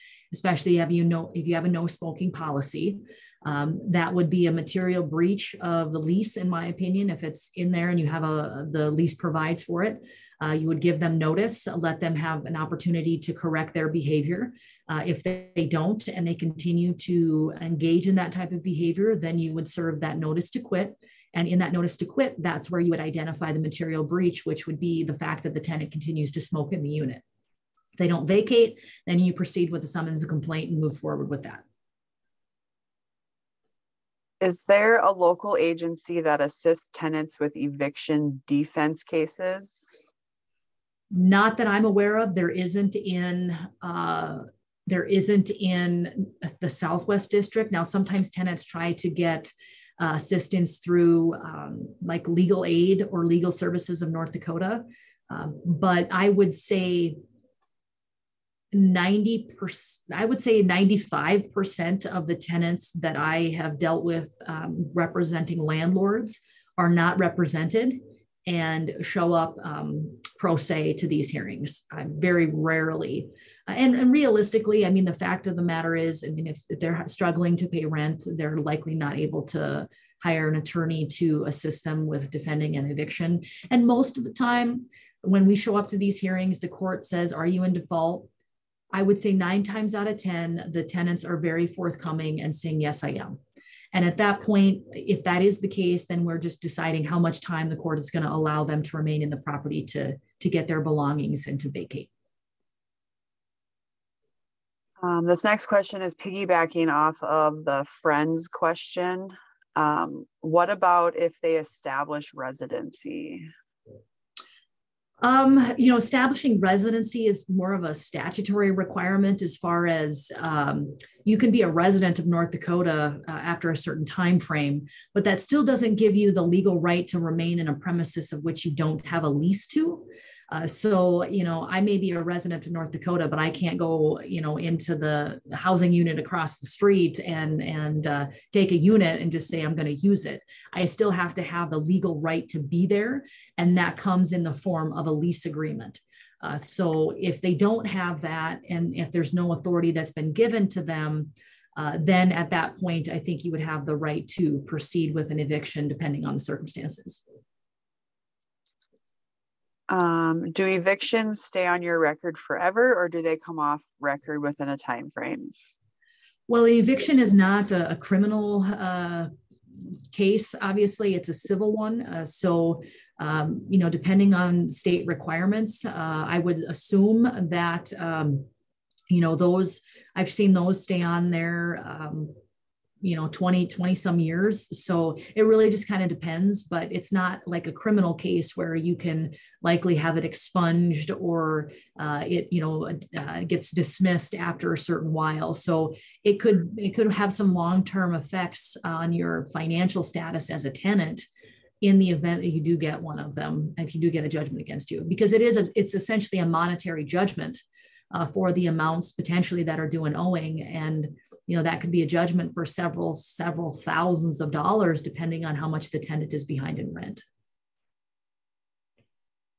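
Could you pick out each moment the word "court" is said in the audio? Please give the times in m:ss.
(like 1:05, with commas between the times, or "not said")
1:26, 1:37.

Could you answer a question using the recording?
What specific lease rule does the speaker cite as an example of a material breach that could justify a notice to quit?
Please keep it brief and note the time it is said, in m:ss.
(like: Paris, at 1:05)
no smoking policy, at 0:01.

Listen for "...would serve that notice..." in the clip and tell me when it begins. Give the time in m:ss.
0:19.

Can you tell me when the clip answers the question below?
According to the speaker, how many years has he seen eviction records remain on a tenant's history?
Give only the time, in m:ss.
3:03.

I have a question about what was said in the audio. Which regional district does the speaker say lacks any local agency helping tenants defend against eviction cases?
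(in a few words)
Southwest District.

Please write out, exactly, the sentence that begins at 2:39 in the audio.
Um, do evictions stay on your record forever or do they come off record within a time frame?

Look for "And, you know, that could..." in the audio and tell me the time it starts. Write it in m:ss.
3:30.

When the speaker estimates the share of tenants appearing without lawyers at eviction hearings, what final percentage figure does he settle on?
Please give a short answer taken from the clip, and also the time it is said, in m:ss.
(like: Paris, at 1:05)
95%, at 1:00.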